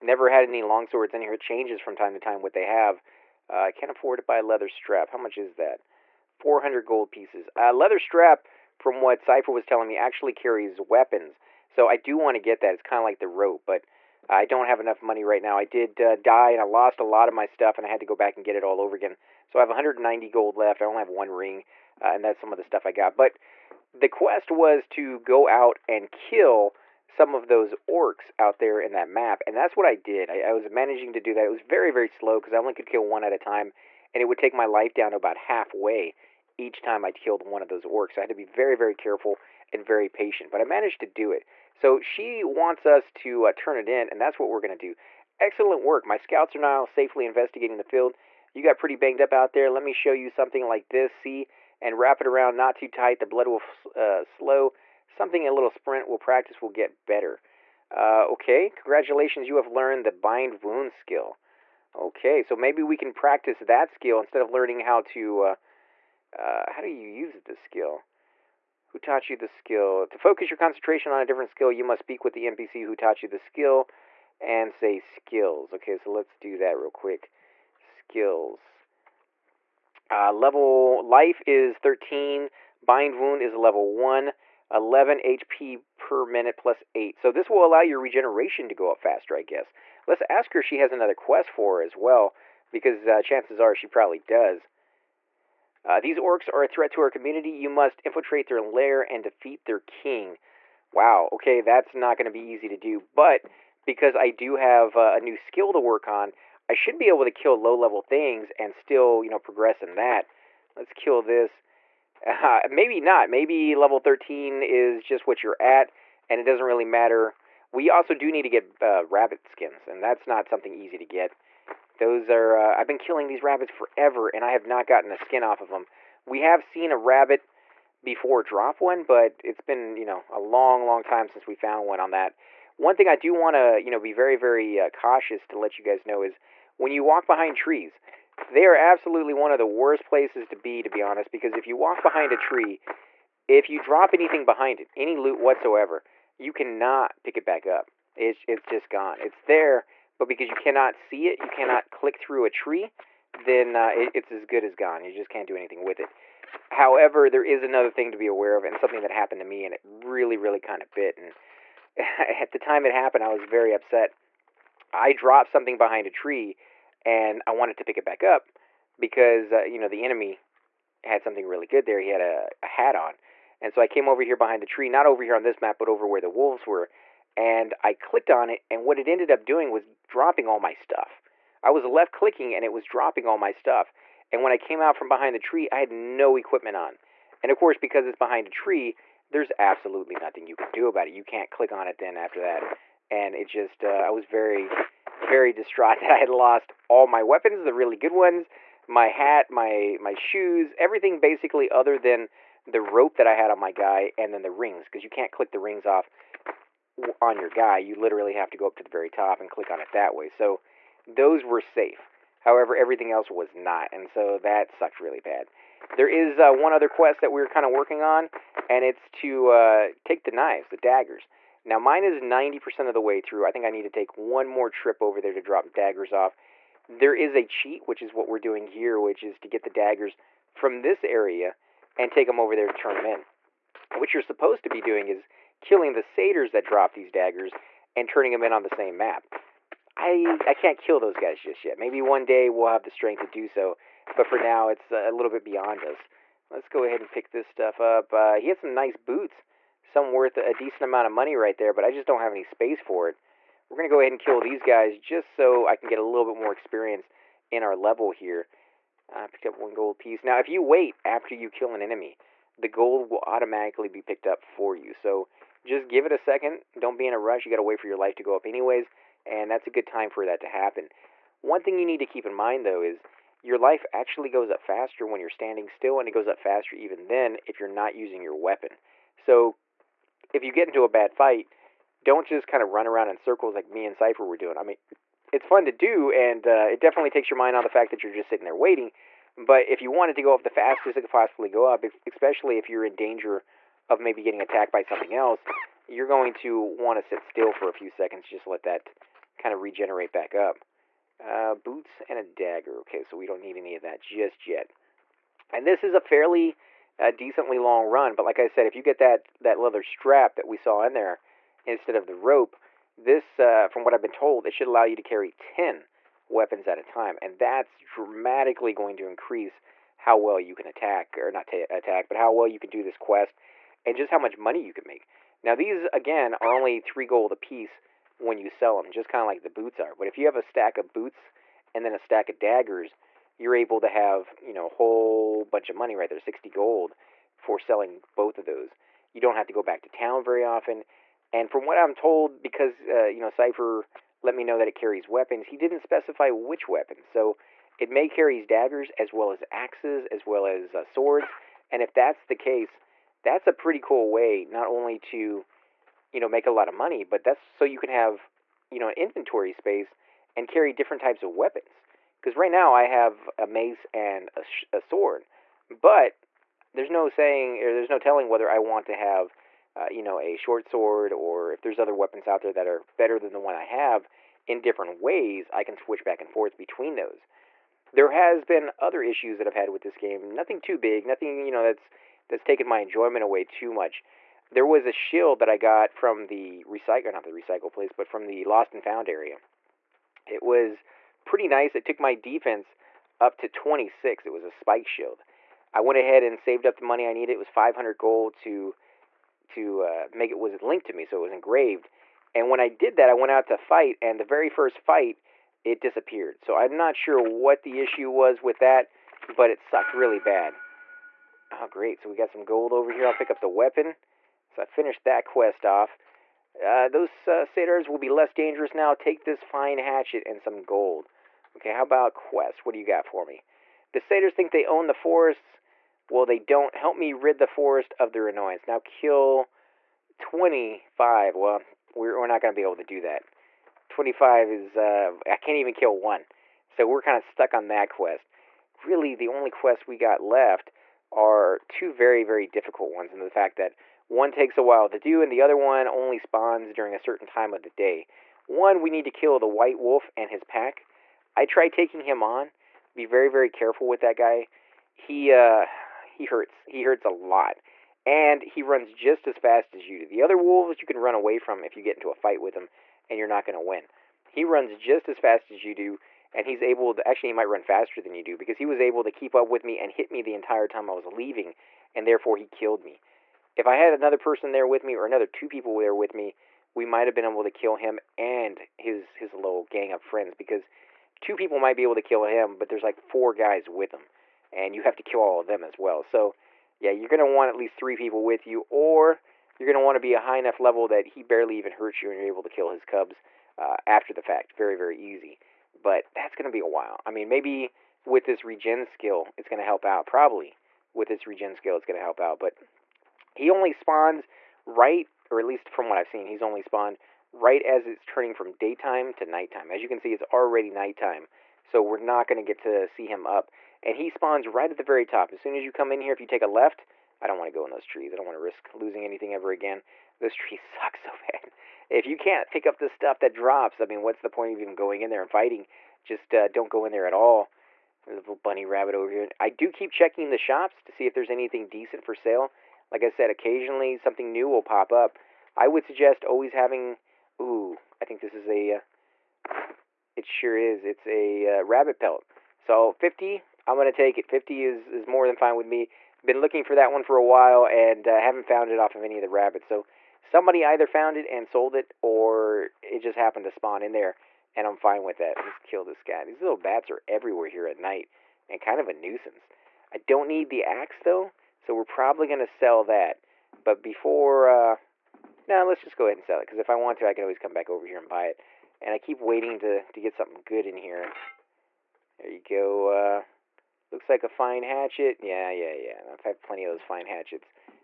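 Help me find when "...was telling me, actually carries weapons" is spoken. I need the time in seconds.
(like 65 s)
9 s.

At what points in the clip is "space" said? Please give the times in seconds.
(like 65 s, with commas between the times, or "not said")
252 s, 359 s.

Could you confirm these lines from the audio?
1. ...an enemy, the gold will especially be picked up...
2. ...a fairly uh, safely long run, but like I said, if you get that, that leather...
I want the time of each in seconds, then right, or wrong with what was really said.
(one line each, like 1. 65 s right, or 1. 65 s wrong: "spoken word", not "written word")
1. 261 s wrong: "automatically", not "especially"
2. 305 s wrong: "decently", not "safely".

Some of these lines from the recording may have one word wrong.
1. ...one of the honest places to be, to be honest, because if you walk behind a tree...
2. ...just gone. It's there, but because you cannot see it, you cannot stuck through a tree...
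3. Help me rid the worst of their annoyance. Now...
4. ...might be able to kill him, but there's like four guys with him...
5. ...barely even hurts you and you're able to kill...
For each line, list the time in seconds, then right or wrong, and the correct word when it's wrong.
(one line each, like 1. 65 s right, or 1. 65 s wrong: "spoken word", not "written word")
1. 139 s wrong: "worst", not "honest"
2. 148 s wrong: "click", not "stuck"
3. 426 s wrong: "forest", not "worst"
4. 481 s right
5. 491 s right.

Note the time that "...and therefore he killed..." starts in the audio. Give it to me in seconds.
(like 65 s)
471 s.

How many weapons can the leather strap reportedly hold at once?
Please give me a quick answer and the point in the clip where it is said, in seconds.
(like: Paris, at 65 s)
10, at 315 s.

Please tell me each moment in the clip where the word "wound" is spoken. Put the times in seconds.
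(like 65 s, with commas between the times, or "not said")
60 s, 83 s.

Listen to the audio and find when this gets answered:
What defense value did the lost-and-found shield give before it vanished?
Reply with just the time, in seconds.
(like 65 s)
393 s.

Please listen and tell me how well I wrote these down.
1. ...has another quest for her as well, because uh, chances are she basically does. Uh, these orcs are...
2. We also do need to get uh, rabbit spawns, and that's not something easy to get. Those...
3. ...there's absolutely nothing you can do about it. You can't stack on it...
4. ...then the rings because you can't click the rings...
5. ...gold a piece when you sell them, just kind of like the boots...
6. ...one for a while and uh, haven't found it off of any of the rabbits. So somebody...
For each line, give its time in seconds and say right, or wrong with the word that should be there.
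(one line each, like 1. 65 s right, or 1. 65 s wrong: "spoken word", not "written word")
1. 90 s wrong: "probably", not "basically"
2. 117 s wrong: "skins", not "spawns"
3. 189 s wrong: "click", not "stack"
4. 204 s right
5. 327 s right
6. 546 s right.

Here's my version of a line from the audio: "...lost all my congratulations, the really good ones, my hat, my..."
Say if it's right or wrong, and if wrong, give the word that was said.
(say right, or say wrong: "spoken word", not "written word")
wrong: "weapons", not "congratulations".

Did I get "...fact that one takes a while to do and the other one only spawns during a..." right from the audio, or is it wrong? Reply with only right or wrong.
right.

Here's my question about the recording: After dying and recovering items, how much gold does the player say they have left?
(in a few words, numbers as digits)
190 gold.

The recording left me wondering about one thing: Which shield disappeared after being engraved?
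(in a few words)
Spike shield.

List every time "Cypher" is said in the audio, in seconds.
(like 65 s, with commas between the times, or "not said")
9 s, 283 s, 343 s.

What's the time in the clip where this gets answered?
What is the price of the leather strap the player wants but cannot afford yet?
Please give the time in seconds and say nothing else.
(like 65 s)
6 s.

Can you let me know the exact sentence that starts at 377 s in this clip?
There has been other issues that I've had with this game.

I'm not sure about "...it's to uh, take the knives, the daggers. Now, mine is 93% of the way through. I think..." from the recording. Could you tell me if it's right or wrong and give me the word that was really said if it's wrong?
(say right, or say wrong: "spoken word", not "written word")
wrong: "90", not "93".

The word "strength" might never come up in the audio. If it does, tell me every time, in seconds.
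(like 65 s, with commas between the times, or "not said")
242 s.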